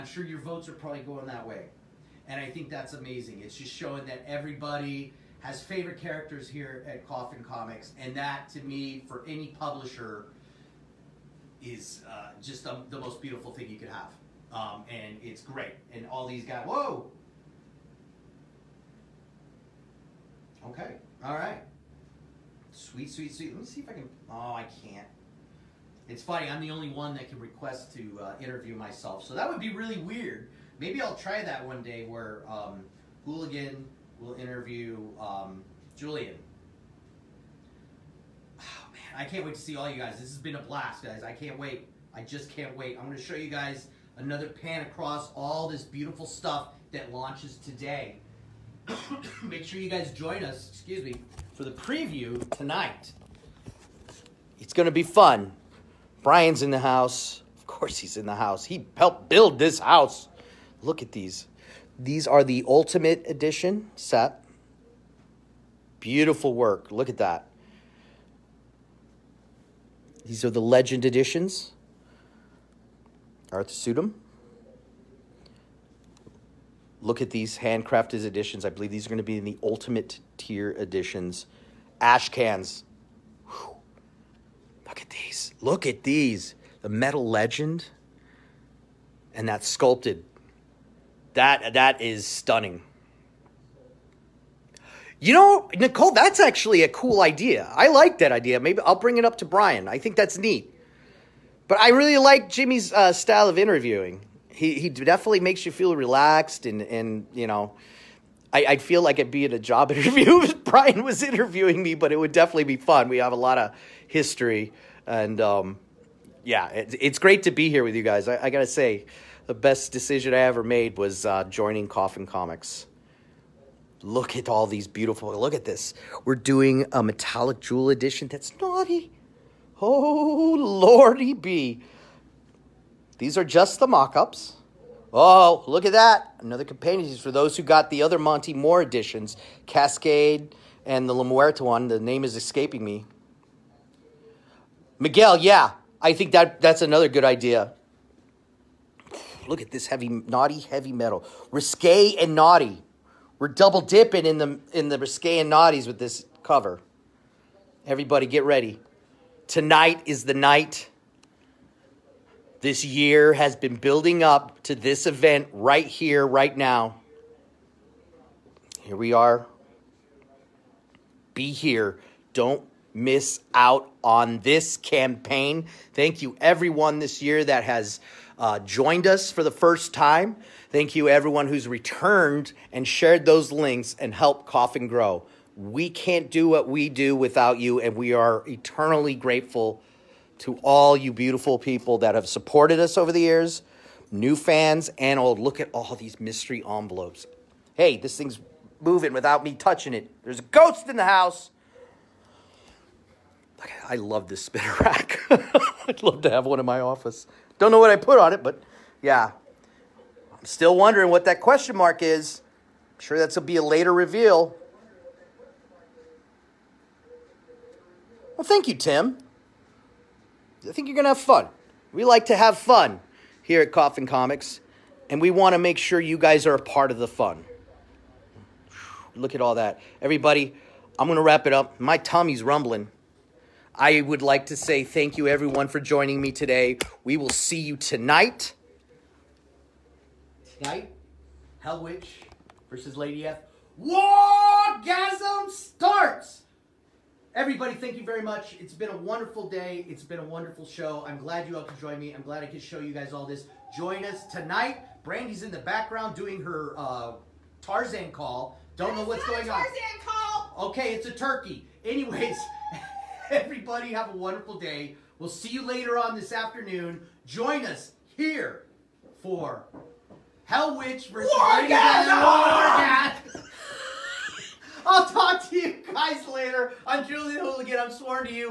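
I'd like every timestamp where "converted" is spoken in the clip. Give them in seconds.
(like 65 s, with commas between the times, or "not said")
not said.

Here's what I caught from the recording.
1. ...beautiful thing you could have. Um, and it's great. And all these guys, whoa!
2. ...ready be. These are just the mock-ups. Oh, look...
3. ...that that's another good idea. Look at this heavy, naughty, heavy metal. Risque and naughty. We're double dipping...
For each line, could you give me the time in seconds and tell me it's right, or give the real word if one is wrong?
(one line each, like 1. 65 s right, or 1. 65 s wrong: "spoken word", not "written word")
1. 13 s right
2. 130 s wrong: "lordy", not "ready"
3. 146 s right.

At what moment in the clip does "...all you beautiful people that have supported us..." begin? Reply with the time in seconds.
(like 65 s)
190 s.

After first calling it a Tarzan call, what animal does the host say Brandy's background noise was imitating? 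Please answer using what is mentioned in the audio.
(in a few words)
turkey.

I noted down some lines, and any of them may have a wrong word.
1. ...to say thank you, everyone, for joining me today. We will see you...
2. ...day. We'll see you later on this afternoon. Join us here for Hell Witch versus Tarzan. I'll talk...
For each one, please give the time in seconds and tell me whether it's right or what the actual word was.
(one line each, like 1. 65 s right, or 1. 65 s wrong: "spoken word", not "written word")
1. 234 s right
2. 264 s wrong: "Wargasm", not "Tarzan".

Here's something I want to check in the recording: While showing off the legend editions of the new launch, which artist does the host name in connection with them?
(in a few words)
Arthur Suydam.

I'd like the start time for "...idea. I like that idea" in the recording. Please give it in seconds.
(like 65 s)
97 s.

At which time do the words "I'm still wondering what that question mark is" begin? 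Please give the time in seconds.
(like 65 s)
210 s.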